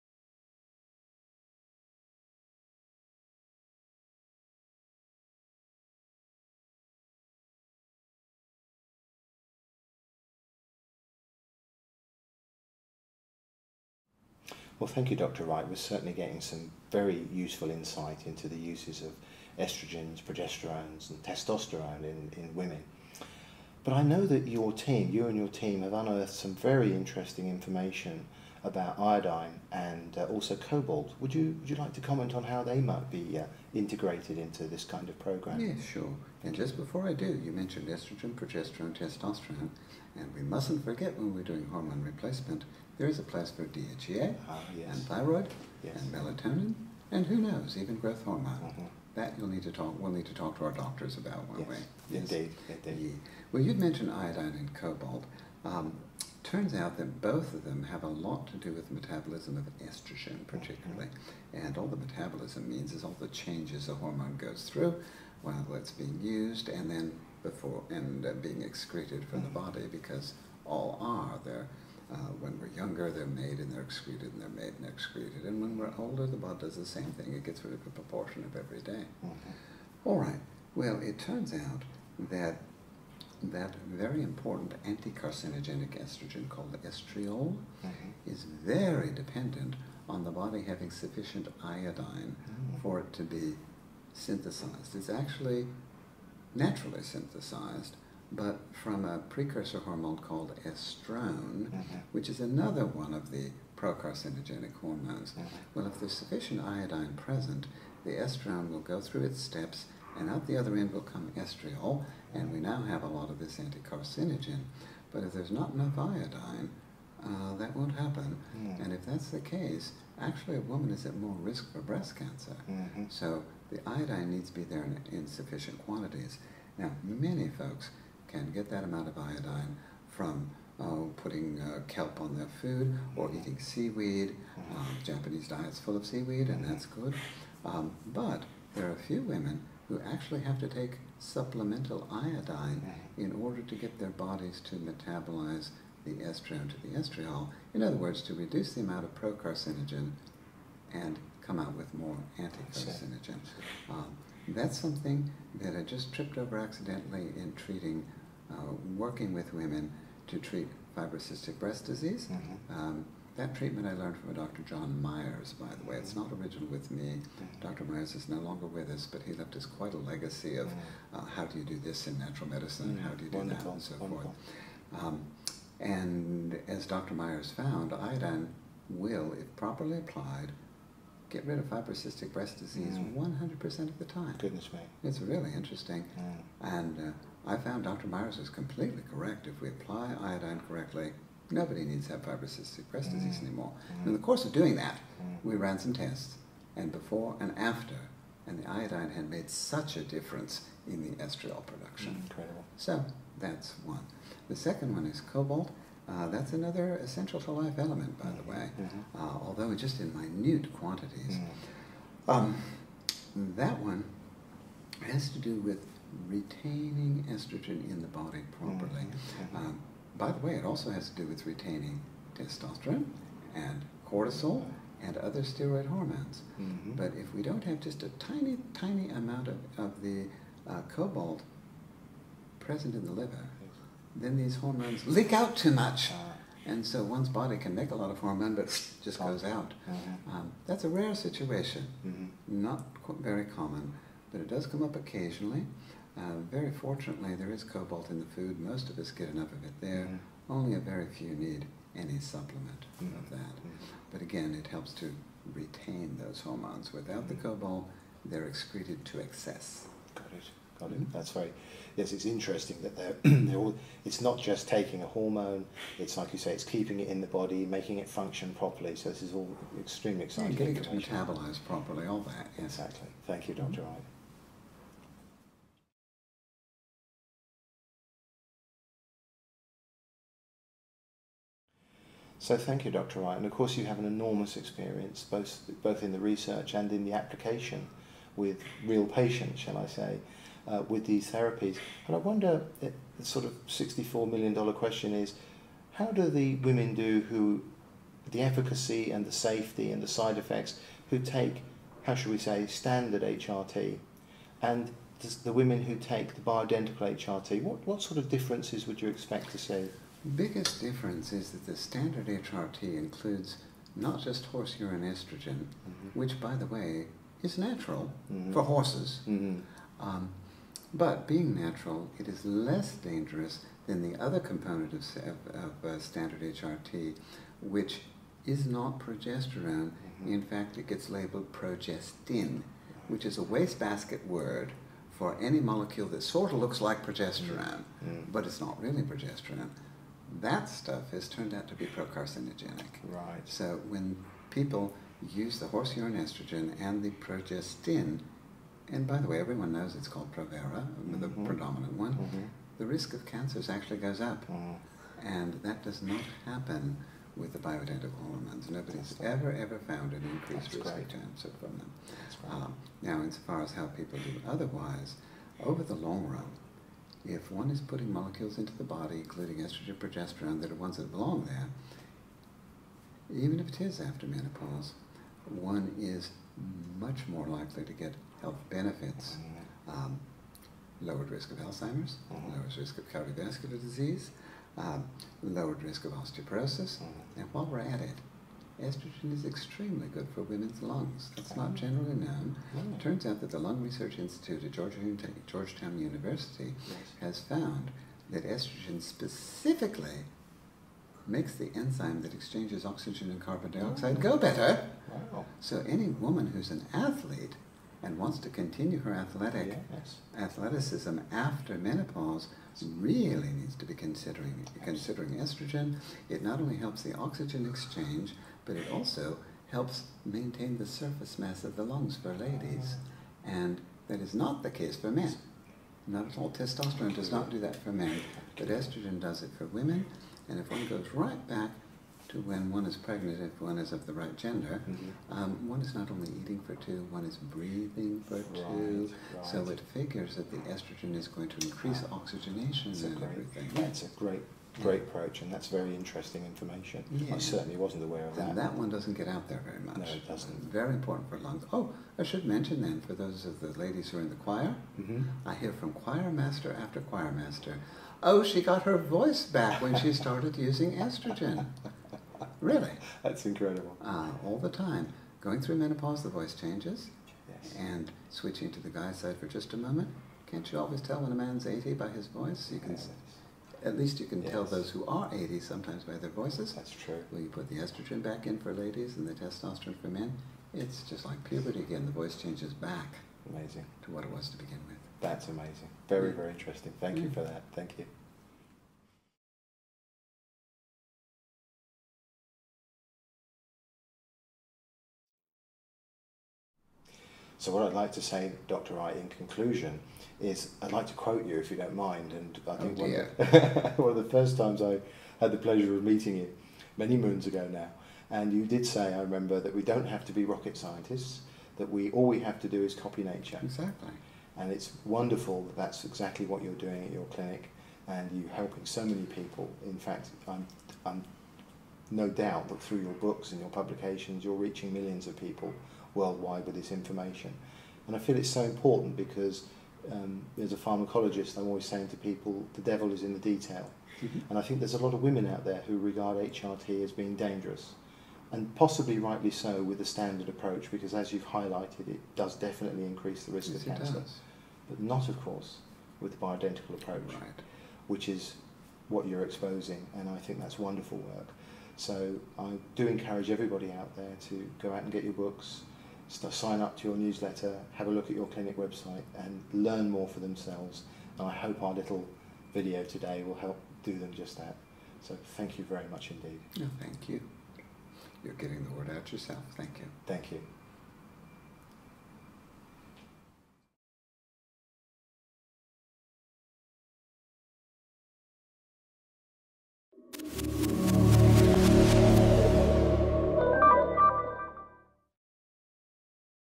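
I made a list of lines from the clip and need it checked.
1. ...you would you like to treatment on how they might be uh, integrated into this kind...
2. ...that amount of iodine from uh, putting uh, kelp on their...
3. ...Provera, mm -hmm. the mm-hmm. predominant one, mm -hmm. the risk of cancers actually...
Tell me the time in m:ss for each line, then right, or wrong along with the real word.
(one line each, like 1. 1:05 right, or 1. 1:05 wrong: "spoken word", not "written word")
1. 0:31 wrong: "comment", not "treatment"
2. 2:08 right
3. 5:50 right.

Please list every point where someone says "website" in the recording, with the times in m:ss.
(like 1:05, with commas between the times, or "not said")
9:18.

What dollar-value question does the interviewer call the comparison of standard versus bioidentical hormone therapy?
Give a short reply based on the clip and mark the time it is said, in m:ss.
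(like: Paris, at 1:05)
$64 million, at 4:53.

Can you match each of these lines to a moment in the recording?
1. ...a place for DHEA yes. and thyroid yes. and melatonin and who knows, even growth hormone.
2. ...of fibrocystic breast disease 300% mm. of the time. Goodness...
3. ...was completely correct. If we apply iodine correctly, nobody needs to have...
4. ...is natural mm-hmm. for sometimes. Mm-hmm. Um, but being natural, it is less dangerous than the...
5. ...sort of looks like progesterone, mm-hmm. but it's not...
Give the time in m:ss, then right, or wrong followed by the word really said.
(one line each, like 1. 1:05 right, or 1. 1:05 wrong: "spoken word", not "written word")
1. 0:43 right
2. 3:01 wrong: "100", not "300"
3. 3:08 right
4. 5:17 wrong: "horses", not "sometimes"
5. 5:36 right.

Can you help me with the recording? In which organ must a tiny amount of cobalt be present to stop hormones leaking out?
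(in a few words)
Liver.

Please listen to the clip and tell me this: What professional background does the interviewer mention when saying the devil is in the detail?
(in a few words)
Pharmacologist.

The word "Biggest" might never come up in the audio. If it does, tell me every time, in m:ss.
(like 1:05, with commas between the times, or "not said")
5:10.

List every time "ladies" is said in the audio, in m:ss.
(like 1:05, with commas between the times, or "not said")
7:02, 7:33, 7:58.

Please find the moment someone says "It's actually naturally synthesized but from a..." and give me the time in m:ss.
1:34.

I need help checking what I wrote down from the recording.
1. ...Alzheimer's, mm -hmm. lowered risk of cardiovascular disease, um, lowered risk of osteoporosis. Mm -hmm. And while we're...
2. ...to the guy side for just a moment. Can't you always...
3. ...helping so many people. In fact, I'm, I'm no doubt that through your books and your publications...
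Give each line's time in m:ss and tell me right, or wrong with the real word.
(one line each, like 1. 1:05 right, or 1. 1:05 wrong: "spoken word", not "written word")
1. 6:21 right
2. 7:48 right
3. 8:38 right.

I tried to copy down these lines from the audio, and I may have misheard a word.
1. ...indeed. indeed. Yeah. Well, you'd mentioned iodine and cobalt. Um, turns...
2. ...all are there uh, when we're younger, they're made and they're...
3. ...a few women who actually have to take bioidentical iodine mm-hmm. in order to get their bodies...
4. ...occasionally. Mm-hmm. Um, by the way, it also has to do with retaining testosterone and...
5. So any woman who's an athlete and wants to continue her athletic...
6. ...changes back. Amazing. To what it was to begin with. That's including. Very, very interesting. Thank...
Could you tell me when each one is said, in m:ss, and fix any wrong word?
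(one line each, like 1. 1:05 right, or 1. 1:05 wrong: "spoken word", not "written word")
1. 0:52 right
2. 1:10 right
3. 2:18 wrong: "supplemental", not "bioidentical"
4. 3:38 wrong: "properly", not "occasionally"
5. 6:45 right
6. 8:02 wrong: "amazing", not "including".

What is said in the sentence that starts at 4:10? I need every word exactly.
Only a very few need any supplement mm -hmm.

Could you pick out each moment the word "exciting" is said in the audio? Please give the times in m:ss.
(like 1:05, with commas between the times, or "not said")
4:30.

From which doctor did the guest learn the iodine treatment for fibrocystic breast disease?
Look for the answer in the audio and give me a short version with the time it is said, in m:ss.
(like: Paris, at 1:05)
John Myers, at 2:44.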